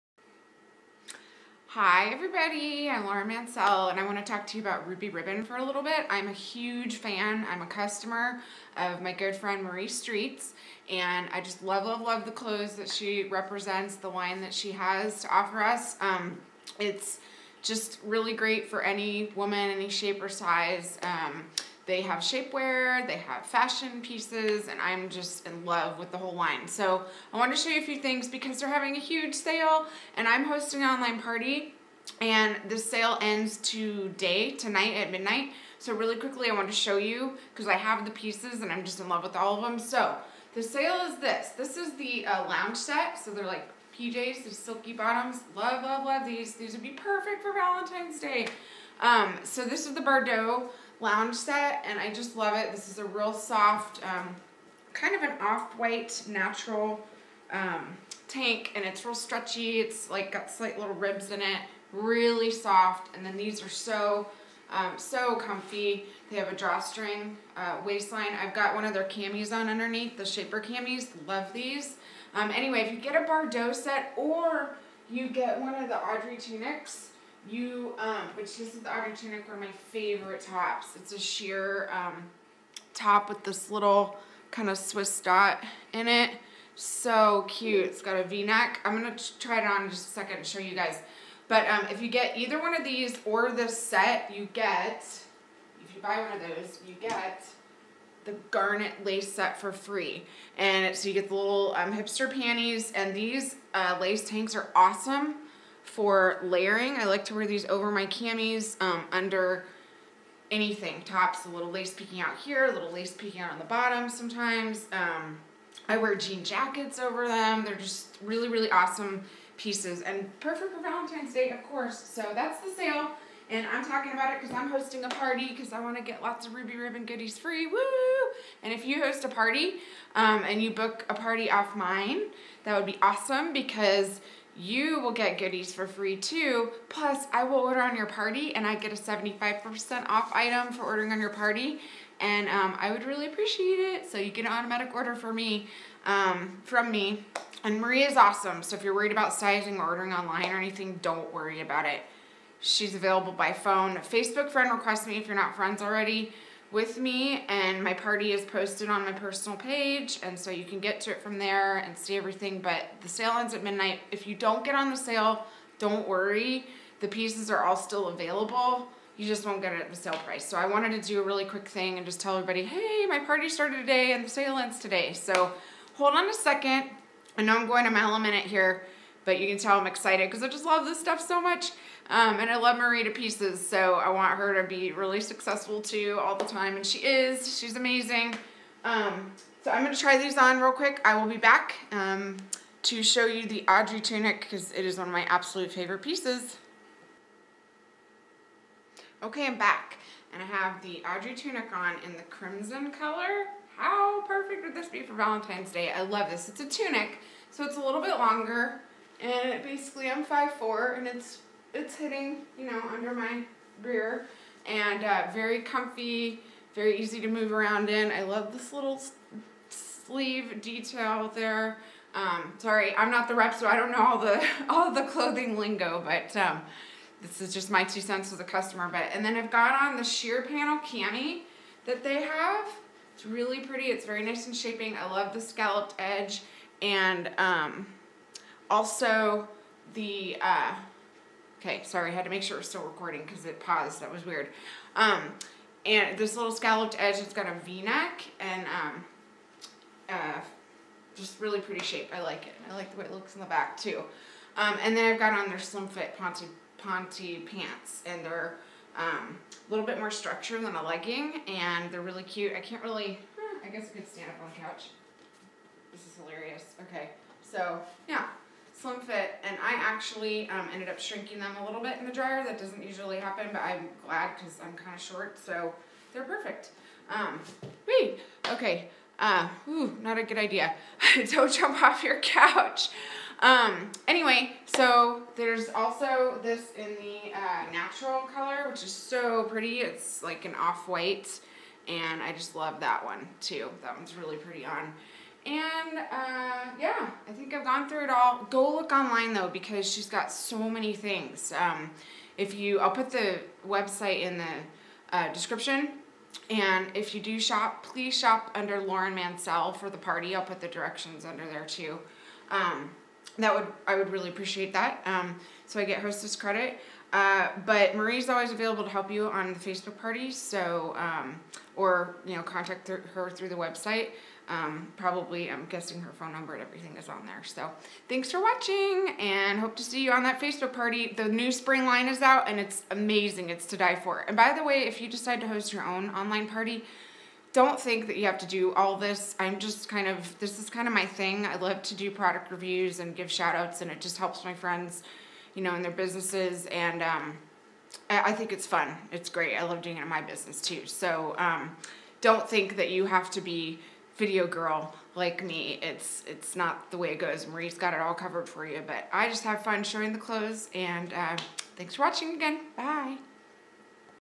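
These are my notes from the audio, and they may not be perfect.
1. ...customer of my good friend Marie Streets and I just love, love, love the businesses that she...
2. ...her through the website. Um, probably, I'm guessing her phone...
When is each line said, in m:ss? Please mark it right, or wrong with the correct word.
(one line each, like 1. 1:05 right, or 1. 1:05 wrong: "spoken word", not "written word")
1. 0:07 wrong: "clothes", not "businesses"
2. 5:23 right.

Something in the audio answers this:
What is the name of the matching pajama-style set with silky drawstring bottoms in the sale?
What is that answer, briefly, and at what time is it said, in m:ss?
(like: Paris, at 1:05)
Bardot lounge set, at 0:49.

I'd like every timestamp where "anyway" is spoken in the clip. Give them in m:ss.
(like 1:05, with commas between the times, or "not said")
1:12, 4:44.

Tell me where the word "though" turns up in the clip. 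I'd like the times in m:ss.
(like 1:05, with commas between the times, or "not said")
4:59.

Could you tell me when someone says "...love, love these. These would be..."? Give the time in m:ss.
0:45.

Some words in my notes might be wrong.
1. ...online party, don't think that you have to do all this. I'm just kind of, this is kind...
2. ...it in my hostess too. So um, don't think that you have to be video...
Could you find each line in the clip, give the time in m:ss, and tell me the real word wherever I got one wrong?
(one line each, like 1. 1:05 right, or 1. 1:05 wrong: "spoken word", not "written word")
1. 5:36 right
2. 5:49 wrong: "business", not "hostess".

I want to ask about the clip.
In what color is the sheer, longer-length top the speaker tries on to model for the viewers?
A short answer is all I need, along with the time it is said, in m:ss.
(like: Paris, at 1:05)
crimson, at 3:22.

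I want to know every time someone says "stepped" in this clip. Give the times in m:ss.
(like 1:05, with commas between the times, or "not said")
not said.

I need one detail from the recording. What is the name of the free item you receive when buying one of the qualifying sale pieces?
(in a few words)
garnet lace set.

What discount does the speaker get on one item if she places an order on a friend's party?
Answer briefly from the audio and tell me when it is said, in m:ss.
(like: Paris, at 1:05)
75%, at 2:18.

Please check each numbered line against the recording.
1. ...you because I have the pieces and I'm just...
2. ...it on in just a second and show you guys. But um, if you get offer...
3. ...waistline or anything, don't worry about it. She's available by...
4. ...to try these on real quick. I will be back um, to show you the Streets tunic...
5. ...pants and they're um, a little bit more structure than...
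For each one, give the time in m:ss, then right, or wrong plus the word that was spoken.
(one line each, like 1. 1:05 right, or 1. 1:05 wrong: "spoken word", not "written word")
1. 0:36 right
2. 1:29 wrong: "either", not "offer"
3. 2:30 wrong: "online", not "waistline"
4. 3:09 wrong: "Audrey", not "Streets"
5. 4:17 right.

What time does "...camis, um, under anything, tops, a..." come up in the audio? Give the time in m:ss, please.
1:48.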